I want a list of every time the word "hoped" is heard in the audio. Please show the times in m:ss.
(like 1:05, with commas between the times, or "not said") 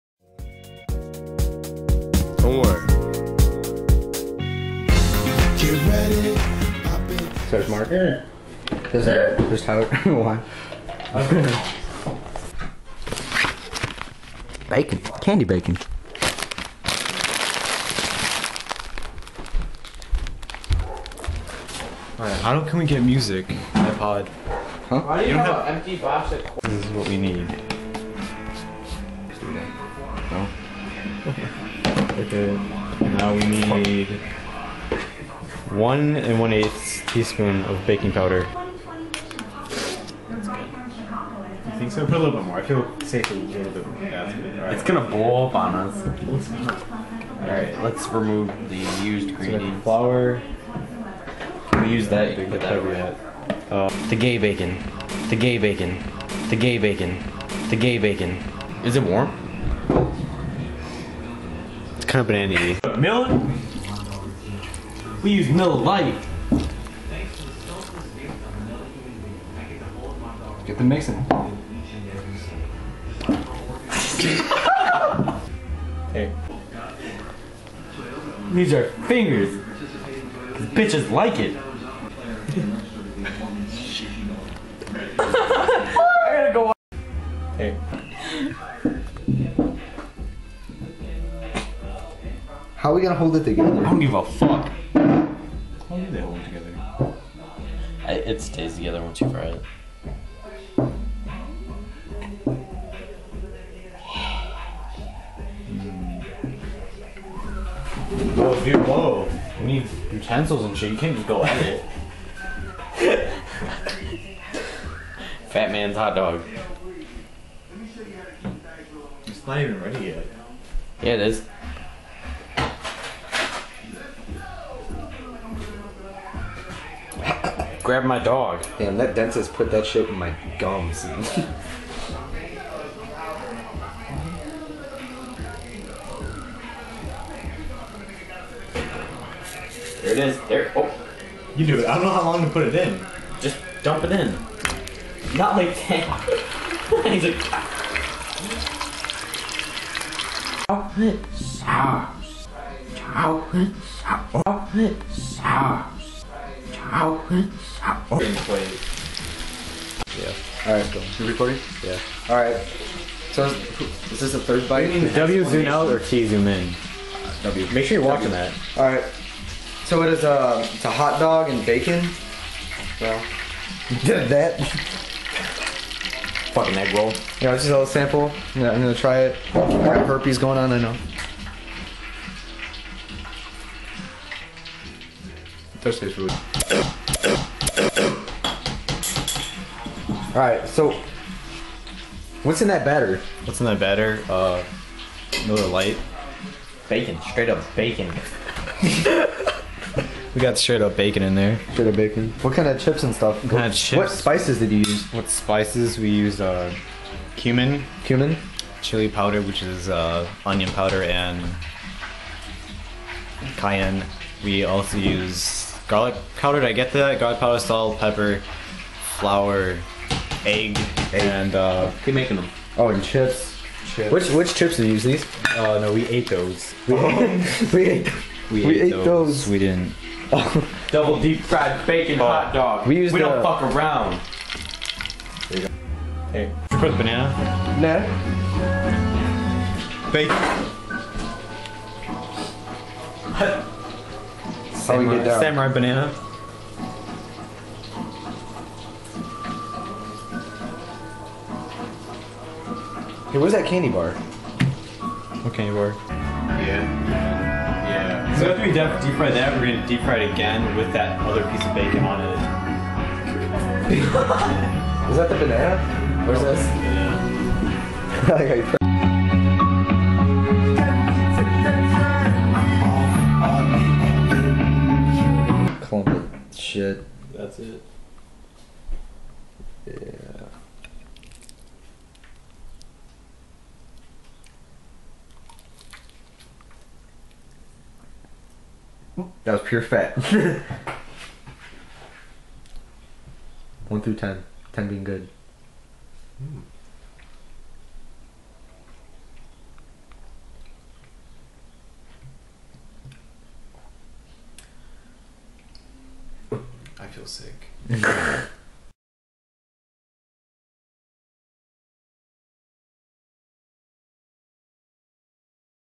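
not said.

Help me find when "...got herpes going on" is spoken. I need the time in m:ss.
2:59.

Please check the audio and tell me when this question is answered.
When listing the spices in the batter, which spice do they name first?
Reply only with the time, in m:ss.
3:25.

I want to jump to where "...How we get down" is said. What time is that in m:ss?
4:05.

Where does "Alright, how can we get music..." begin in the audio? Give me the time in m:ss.
0:22.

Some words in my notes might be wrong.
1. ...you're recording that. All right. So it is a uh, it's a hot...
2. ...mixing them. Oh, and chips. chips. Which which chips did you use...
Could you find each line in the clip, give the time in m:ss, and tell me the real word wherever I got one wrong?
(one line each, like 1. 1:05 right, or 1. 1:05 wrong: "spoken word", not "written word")
1. 2:48 wrong: "watching", not "recording"
2. 3:42 wrong: "making", not "mixing".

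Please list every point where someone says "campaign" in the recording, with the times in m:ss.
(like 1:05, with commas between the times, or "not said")
not said.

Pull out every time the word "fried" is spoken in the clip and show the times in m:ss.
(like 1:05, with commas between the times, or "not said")
3:51.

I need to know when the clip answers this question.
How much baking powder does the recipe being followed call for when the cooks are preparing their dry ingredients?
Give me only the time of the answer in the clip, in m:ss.
0:35.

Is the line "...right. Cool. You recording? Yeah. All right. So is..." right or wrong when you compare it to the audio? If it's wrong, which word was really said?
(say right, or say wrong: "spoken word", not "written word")
right.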